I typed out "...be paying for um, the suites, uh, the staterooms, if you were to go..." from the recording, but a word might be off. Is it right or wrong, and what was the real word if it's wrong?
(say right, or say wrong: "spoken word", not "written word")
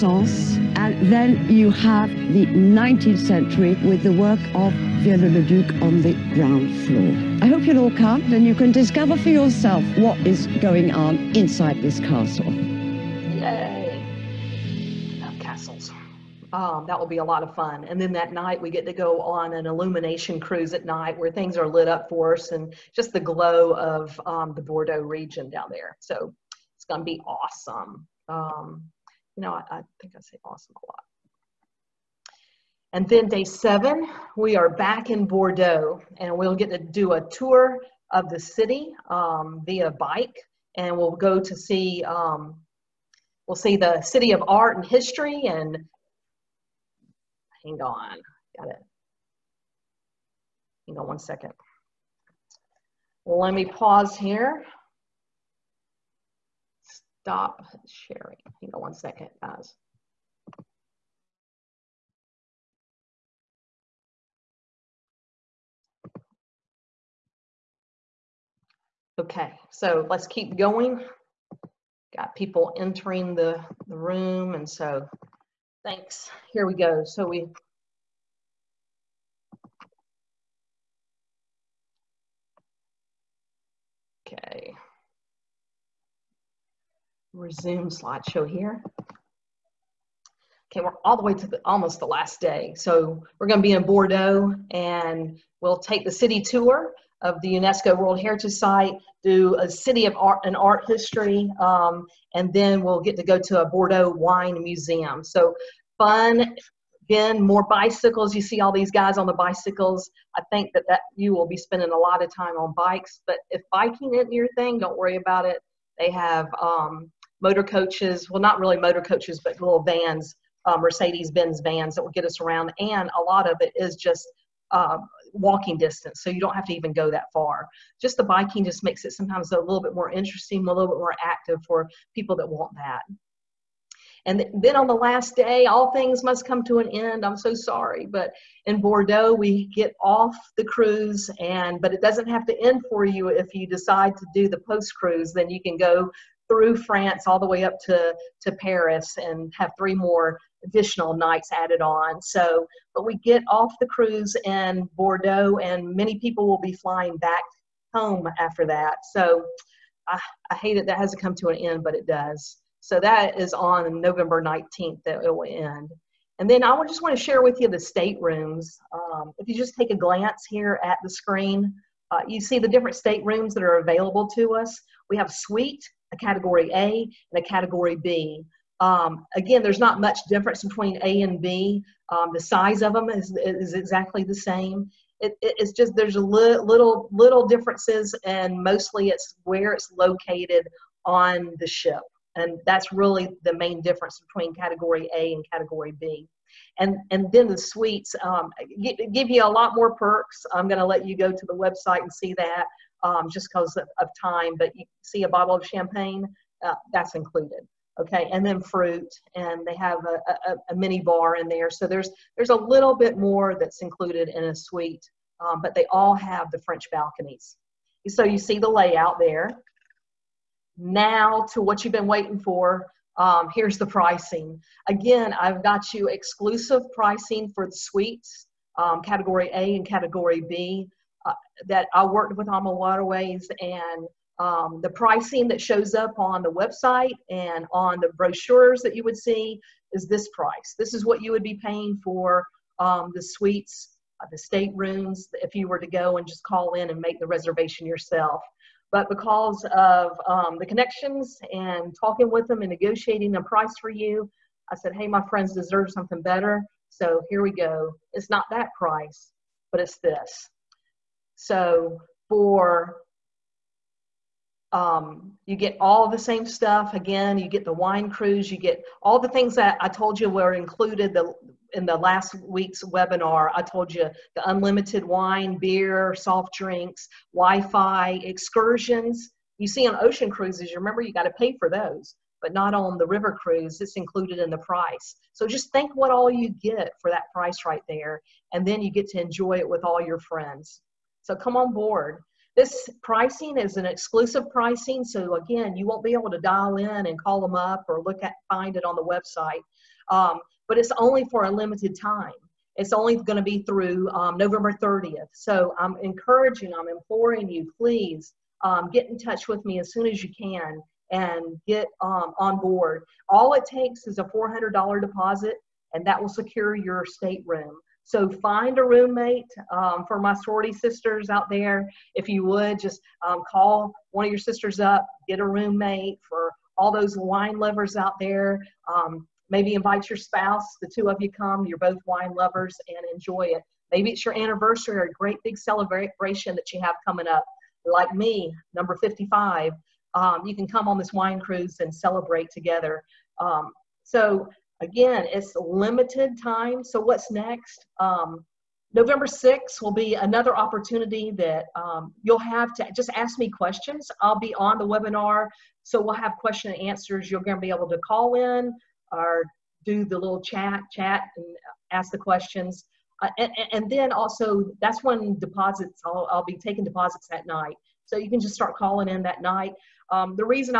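right.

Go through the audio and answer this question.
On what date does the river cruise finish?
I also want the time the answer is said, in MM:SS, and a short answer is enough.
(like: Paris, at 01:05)
November 19th, at 02:43.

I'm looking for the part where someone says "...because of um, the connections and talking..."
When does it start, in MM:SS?
04:09.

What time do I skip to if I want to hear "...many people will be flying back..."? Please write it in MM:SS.
02:35.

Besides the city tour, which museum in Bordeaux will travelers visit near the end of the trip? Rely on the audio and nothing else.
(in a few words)
Bordeaux wine museum.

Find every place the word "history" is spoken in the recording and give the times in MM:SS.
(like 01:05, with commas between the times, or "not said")
00:44, 01:40.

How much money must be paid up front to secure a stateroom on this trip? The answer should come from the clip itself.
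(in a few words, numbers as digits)
$400.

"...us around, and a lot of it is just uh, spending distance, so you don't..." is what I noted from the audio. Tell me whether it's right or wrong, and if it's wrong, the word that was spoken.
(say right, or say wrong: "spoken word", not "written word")
wrong: "walking", not "spending".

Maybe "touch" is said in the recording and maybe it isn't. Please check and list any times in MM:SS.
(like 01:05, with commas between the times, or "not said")
05:09.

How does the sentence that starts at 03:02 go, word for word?
Um, the size of them is, is exactly the same.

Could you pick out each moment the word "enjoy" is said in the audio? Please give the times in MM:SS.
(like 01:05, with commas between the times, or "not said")
04:49, 05:33.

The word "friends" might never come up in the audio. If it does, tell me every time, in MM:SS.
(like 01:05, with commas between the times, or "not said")
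04:15, 04:50.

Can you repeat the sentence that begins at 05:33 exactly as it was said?
Maybe it's your anniversary or a great big celebration that you have coming up.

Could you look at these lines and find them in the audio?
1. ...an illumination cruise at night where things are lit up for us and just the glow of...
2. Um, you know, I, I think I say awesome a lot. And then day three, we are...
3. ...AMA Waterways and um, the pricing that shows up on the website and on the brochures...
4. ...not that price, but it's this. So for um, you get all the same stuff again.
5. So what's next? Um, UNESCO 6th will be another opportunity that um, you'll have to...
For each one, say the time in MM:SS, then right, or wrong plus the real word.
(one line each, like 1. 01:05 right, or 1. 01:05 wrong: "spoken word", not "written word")
1. 00:19 right
2. 00:28 wrong: "seven", not "three"
3. 03:52 right
4. 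04:18 right
5. 05:46 wrong: "November", not "UNESCO".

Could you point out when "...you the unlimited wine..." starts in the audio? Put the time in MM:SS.
04:33.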